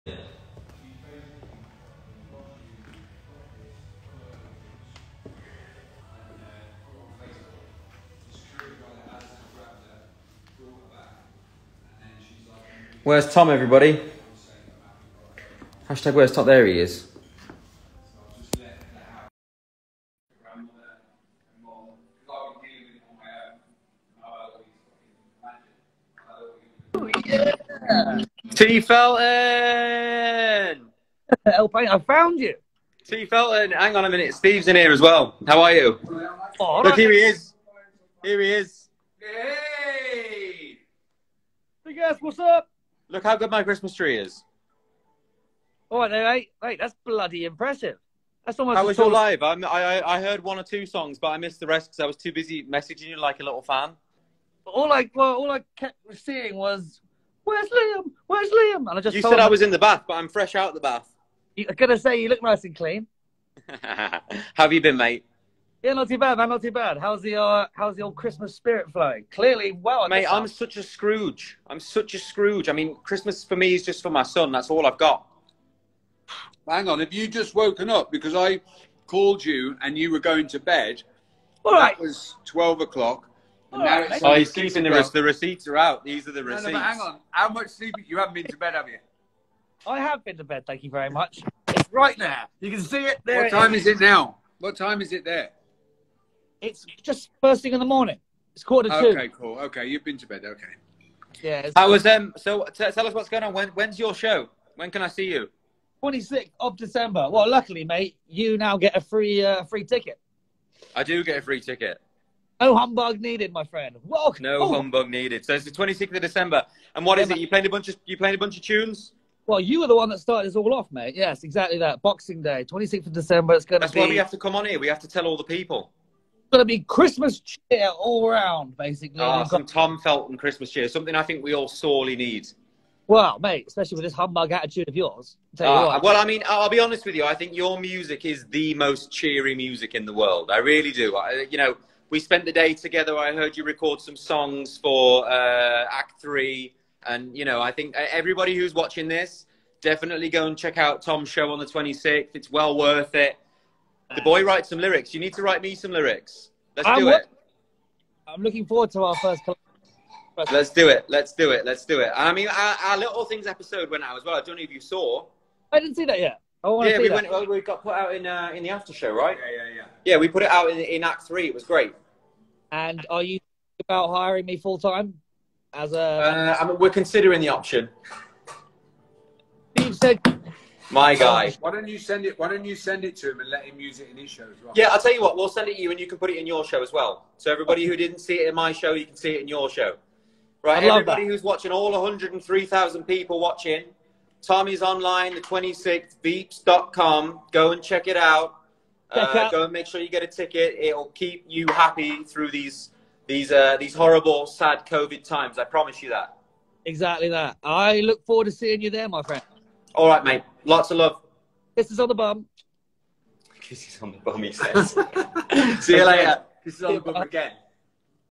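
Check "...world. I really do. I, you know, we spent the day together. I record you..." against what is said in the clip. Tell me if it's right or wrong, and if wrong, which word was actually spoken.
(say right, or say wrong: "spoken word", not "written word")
wrong: "heard", not "record".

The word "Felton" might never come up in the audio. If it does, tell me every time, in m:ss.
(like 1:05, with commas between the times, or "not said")
0:28, 0:33, 2:09.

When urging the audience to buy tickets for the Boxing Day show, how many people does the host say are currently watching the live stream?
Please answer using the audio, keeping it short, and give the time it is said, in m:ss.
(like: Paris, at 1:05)
103,000, at 3:11.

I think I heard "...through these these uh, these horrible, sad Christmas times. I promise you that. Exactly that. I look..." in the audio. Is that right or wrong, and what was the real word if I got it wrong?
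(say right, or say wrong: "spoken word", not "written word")
wrong: "COVID", not "Christmas".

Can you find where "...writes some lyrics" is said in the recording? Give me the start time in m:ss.
2:34.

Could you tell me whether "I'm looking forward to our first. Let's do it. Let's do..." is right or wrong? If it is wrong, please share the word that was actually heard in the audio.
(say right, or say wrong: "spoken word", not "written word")
right.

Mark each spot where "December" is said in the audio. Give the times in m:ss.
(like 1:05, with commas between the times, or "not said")
1:46, 1:56, 2:03.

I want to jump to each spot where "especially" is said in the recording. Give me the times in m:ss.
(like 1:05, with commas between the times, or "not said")
2:13.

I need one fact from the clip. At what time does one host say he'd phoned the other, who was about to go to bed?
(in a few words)
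12 o'clock.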